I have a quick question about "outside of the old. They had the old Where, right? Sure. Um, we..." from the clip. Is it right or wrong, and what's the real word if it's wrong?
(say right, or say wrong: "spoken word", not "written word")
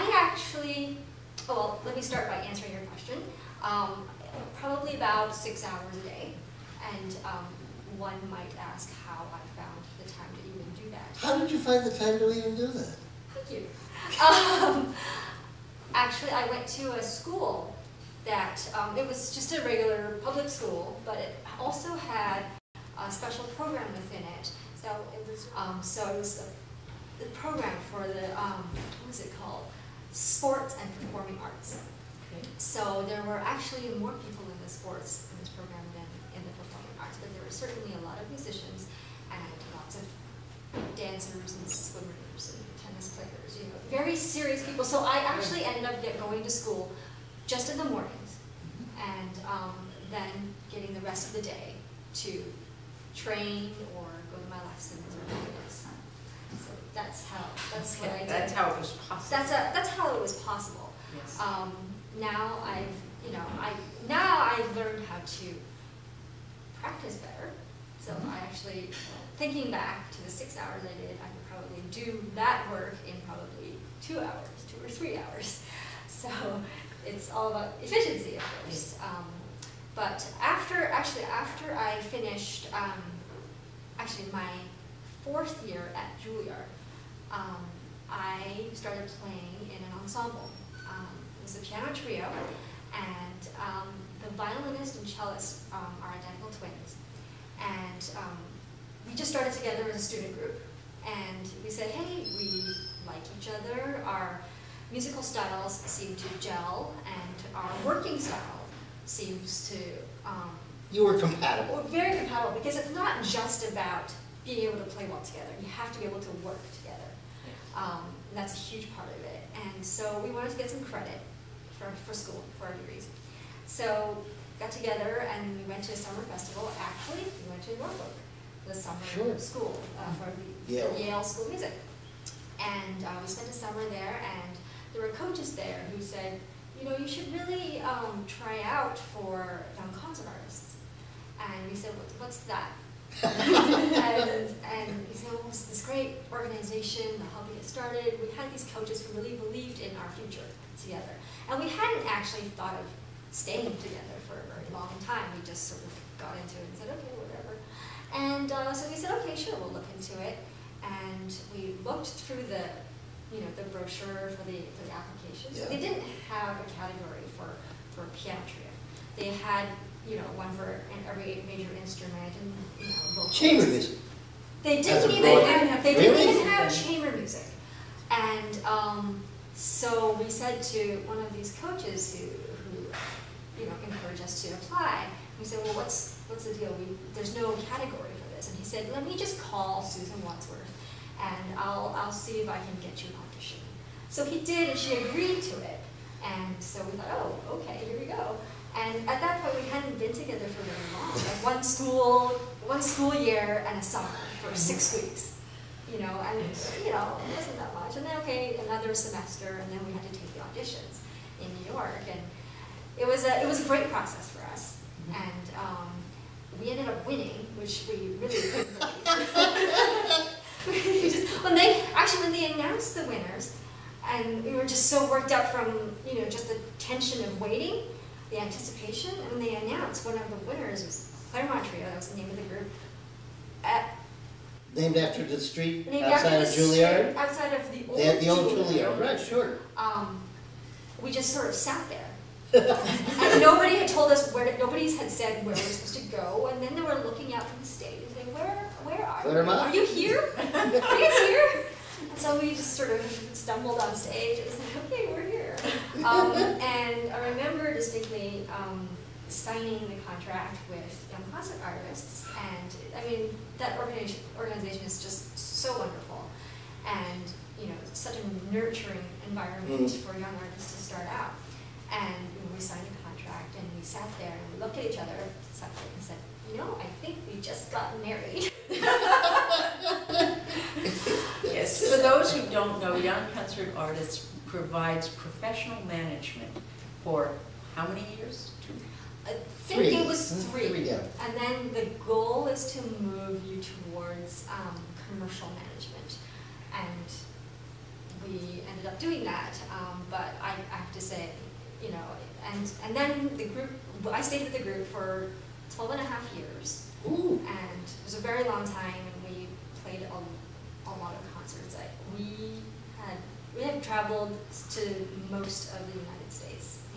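wrong: "Juilliard", not "Where".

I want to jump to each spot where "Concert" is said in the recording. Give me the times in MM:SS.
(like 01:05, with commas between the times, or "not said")
02:19, 04:43.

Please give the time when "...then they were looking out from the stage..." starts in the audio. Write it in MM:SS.
04:06.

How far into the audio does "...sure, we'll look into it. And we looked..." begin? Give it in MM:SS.
02:39.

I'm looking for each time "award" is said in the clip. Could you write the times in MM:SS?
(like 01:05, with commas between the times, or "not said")
not said.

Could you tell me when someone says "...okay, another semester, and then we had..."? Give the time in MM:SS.
03:28.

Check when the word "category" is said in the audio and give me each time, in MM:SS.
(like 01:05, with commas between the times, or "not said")
02:46, 03:07.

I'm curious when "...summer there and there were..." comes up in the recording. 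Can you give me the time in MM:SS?
02:13.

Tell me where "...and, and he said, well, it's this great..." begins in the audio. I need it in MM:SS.
02:23.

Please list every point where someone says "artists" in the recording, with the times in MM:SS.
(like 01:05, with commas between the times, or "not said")
02:20, 04:21, 04:30, 04:43.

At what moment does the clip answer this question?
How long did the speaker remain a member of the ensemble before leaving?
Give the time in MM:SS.
05:05.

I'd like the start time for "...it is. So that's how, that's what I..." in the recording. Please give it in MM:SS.
00:55.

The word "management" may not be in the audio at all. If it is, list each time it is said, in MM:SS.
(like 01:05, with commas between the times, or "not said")
04:45, 04:55.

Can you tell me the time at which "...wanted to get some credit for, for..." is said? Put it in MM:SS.
02:00.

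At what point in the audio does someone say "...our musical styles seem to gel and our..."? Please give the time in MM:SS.
01:44.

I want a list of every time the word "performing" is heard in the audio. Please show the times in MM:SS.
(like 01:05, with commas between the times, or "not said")
00:31, 00:36.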